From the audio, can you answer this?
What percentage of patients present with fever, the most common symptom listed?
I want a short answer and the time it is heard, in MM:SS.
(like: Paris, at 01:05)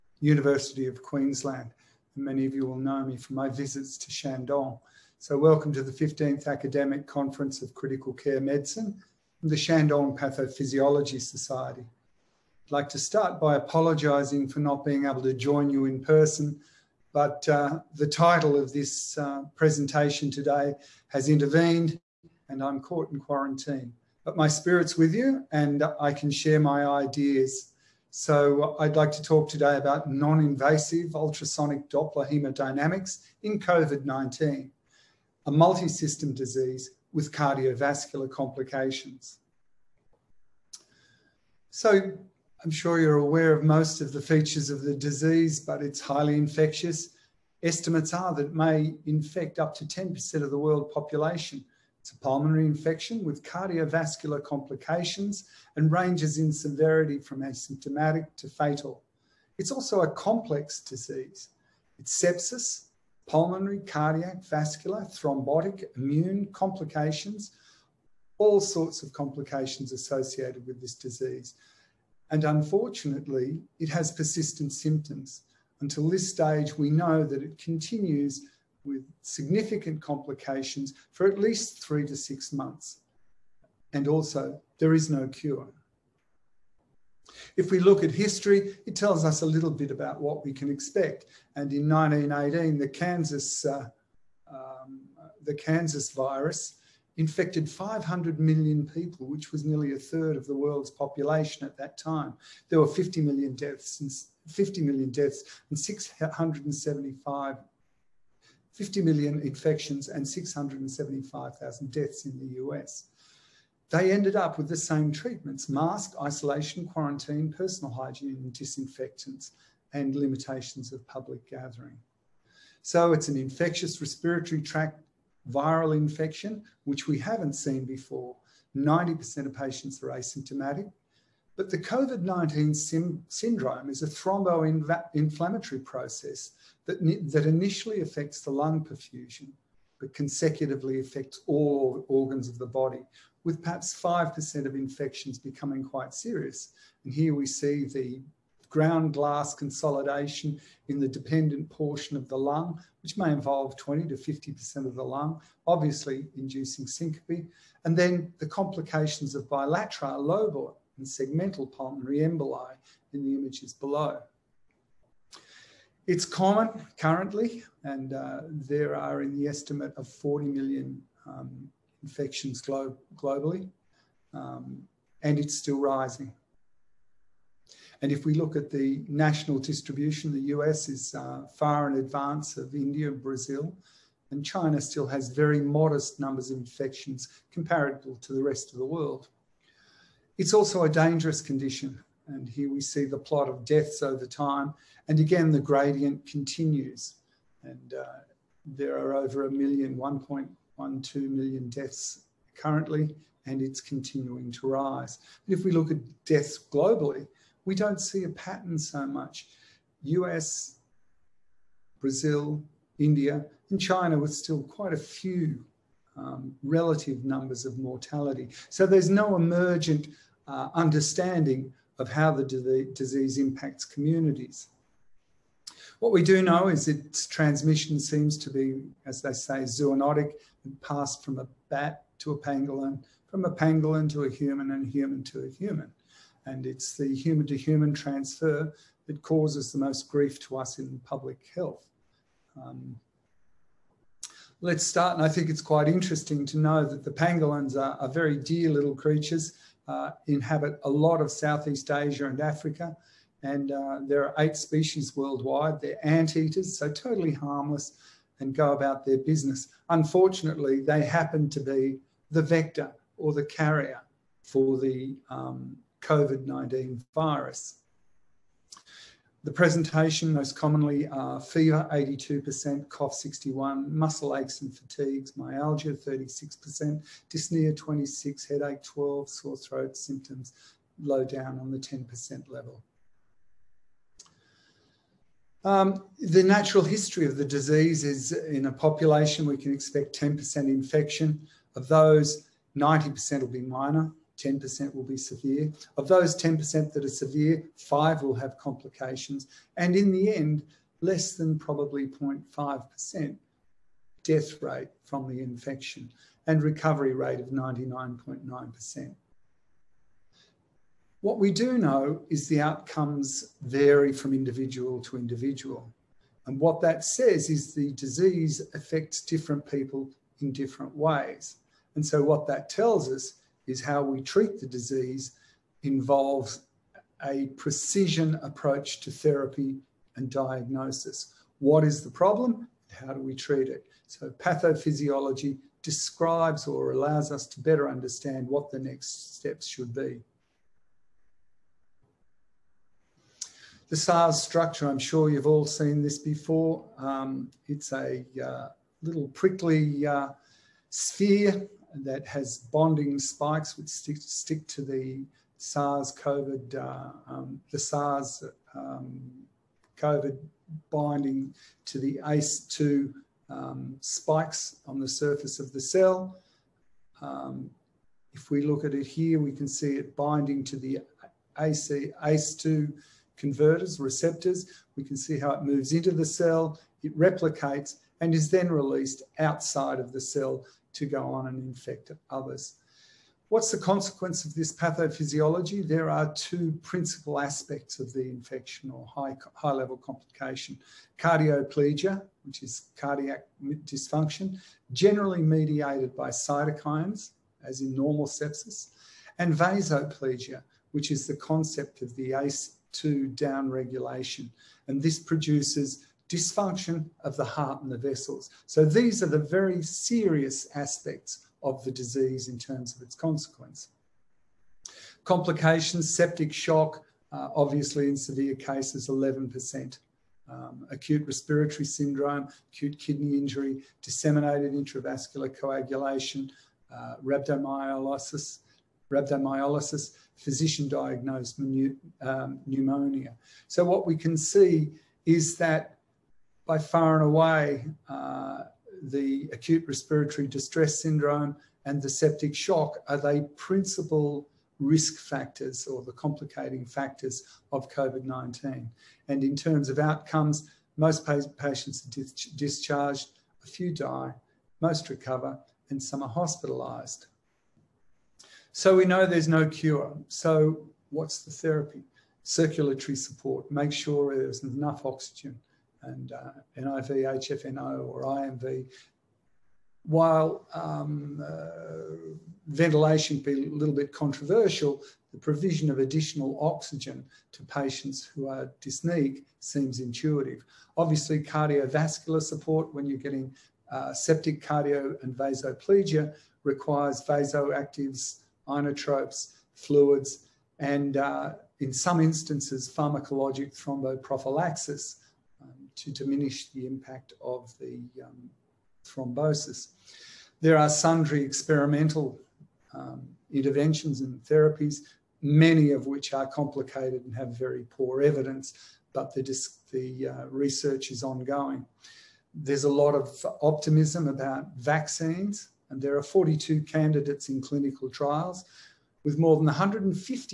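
82%, at 04:31.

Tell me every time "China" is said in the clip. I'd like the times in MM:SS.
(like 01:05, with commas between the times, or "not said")
03:04, 03:33.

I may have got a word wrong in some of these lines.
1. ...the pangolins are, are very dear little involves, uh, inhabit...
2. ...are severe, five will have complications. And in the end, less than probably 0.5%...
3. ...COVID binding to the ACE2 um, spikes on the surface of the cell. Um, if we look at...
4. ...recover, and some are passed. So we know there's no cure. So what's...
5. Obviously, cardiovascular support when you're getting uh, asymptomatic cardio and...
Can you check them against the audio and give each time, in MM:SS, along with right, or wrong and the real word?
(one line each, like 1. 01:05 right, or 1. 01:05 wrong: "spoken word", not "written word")
1. 04:07 wrong: "creatures", not "involves"
2. 04:57 right
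3. 05:59 right
4. 07:35 wrong: "hospitalised", not "passed"
5. 08:00 wrong: "septic", not "asymptomatic".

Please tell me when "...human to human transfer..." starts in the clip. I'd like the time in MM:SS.
03:57.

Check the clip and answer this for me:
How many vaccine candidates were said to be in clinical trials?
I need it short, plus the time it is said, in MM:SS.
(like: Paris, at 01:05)
42, at 08:36.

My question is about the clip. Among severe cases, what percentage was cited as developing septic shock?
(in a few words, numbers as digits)
11%.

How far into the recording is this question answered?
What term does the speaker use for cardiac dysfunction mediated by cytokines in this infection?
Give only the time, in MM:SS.
06:31.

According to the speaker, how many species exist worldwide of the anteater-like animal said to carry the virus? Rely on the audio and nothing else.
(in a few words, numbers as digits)
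8.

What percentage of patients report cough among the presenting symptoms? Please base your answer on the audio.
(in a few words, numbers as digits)
61.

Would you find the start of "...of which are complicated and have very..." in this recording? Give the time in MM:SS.
08:25.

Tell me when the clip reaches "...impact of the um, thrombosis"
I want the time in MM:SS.
08:16.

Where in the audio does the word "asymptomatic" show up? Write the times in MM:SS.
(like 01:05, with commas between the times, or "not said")
00:57, 02:10.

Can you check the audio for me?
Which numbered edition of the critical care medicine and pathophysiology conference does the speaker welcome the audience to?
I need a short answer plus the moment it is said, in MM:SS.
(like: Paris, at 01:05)
15th, at 00:05.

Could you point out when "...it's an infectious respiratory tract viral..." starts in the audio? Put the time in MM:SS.
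02:03.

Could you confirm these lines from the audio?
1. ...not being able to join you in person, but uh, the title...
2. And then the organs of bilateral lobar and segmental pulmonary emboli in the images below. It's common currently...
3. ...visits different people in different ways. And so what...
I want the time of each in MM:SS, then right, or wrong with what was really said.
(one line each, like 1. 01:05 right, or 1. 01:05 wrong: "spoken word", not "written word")
1. 00:14 right
2. 02:37 wrong: "complications", not "organs"
3. 05:18 wrong: "affects", not "visits".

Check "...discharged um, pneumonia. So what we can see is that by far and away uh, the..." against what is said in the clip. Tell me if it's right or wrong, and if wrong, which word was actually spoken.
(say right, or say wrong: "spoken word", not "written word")
wrong: "diagnosed", not "discharged".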